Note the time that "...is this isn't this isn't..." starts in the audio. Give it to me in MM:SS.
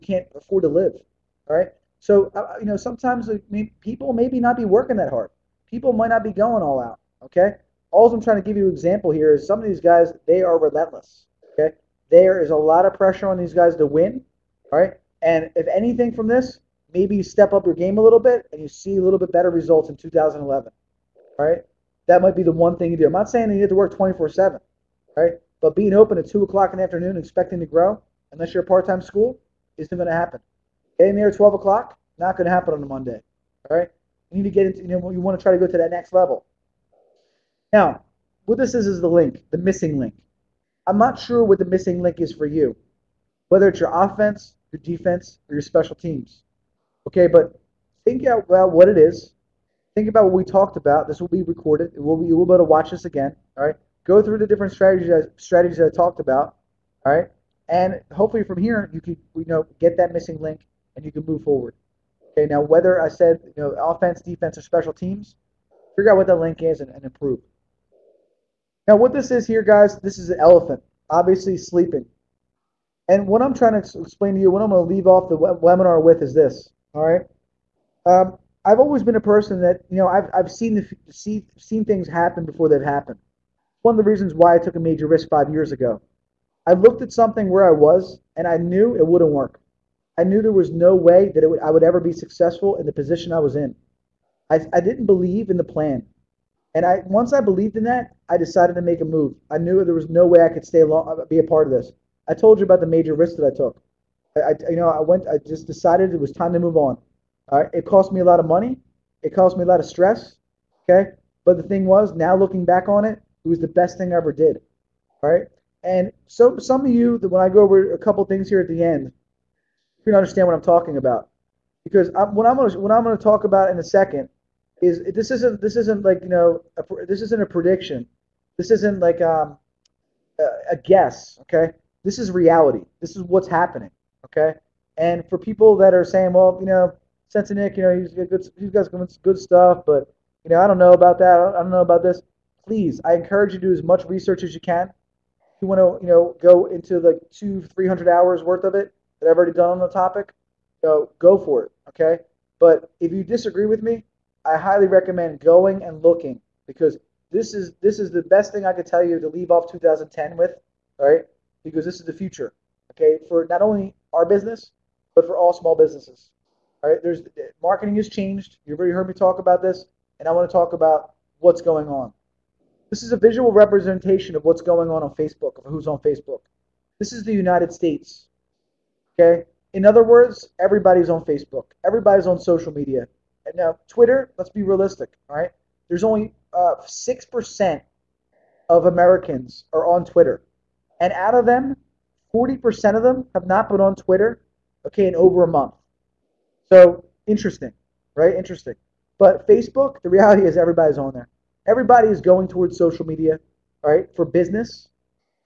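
02:04.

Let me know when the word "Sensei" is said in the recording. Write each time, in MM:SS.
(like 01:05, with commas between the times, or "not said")
02:17.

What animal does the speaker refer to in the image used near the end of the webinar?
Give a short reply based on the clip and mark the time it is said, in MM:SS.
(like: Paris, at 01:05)
Elephant, at 01:10.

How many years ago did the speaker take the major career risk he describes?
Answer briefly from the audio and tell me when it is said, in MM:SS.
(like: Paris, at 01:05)
5, at 01:25.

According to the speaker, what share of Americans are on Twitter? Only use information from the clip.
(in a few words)
6%.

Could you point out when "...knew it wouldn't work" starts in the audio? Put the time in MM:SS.
01:28.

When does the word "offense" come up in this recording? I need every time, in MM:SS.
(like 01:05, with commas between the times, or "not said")
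00:43, 01:03.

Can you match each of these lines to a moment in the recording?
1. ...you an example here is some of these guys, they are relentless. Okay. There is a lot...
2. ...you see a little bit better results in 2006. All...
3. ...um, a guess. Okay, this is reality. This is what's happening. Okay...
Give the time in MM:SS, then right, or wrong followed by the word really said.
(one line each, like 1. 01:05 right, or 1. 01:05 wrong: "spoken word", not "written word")
1. 00:08 right
2. 00:18 wrong: "2011", not "2006"
3. 02:09 right.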